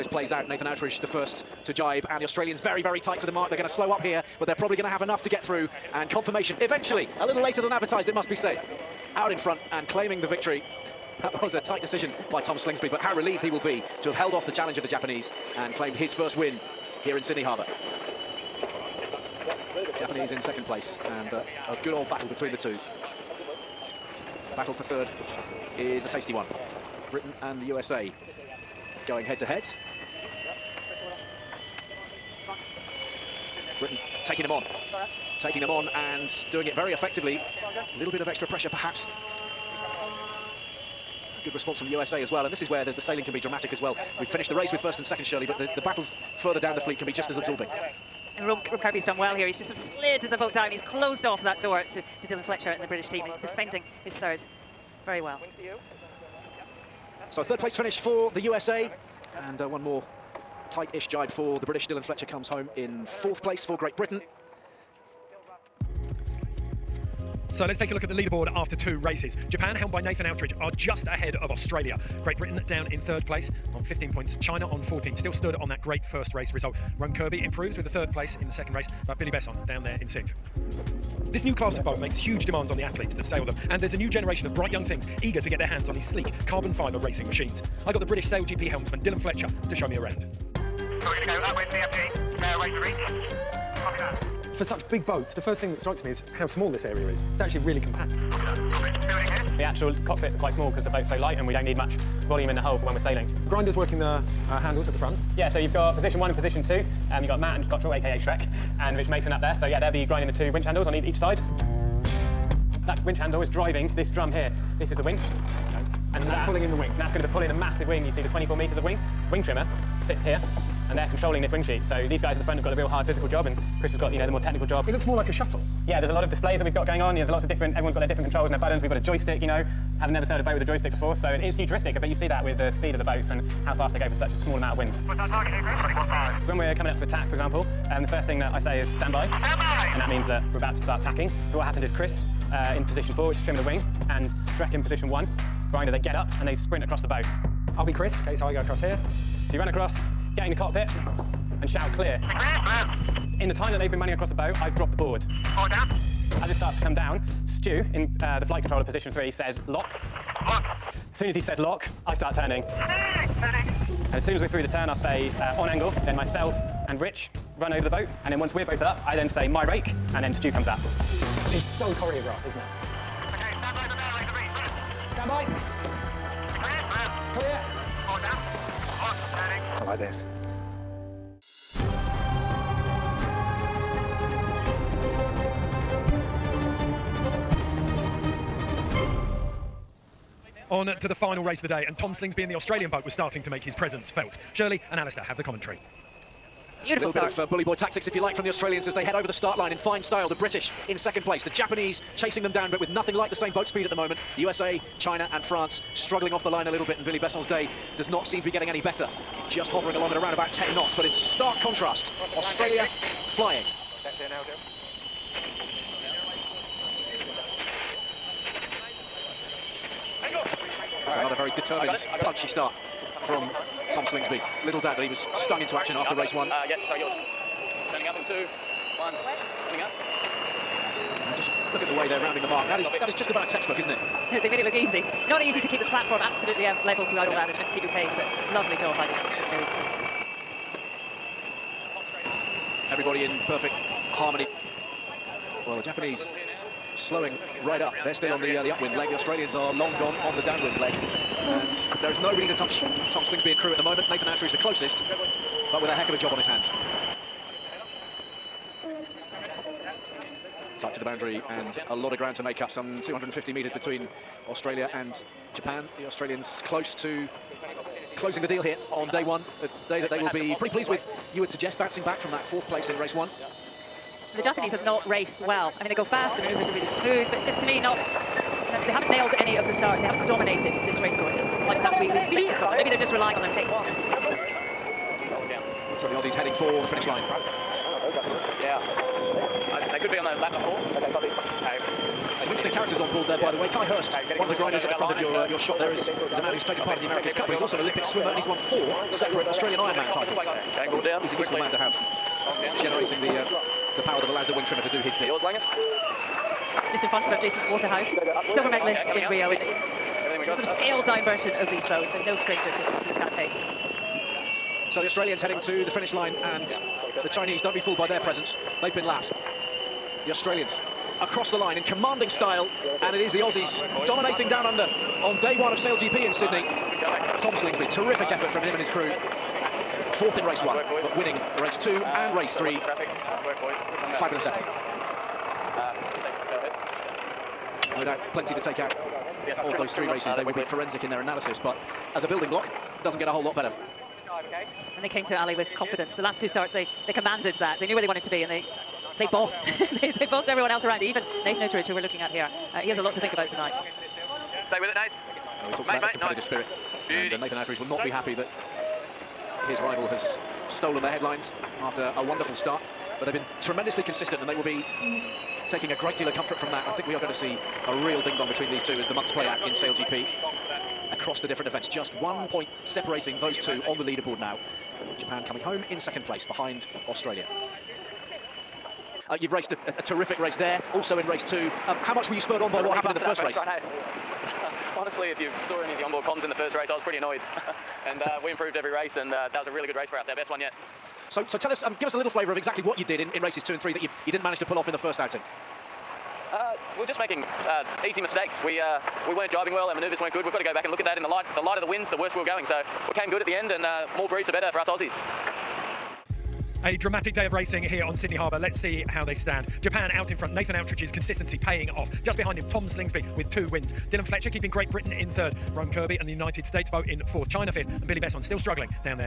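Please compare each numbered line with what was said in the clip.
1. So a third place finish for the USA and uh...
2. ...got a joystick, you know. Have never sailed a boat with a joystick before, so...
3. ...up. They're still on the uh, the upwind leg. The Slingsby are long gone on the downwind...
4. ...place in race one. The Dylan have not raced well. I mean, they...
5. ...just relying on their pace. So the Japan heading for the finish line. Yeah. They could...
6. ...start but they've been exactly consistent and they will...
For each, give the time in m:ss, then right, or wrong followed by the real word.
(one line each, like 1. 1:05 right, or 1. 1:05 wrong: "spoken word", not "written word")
1. 0:57 right
2. 2:08 right
3. 4:07 wrong: "Australians", not "Slingsby"
4. 4:32 wrong: "Japanese", not "Dylan"
5. 4:42 wrong: "Aussies", not "Japan"
6. 6:02 wrong: "tremendously", not "exactly".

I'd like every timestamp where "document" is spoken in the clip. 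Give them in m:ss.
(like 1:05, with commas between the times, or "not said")
not said.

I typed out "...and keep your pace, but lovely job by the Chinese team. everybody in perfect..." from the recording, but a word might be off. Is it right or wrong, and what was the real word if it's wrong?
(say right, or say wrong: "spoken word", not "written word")
wrong: "Australian", not "Chinese".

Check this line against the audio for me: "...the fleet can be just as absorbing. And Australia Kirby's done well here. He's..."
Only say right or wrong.
wrong.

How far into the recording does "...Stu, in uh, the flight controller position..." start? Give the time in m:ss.
2:37.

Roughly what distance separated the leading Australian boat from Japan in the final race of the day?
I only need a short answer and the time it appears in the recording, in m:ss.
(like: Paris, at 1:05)
250 metres, at 4:23.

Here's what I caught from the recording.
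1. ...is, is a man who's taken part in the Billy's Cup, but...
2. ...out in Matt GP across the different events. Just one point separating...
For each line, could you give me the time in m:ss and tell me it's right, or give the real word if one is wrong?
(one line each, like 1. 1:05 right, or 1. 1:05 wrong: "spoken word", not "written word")
1. 4:55 wrong: "America", not "Billy"
2. 6:09 wrong: "Sail", not "Matt".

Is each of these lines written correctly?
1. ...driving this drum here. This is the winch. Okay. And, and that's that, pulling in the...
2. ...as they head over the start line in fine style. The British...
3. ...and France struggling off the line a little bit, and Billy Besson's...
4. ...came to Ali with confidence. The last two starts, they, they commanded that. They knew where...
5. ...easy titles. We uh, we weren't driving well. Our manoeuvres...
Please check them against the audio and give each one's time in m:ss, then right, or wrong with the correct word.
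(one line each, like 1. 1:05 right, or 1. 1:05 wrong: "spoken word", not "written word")
1. 1:53 right
2. 3:18 right
3. 3:25 right
4. 5:45 right
5. 6:38 wrong: "mistakes", not "titles".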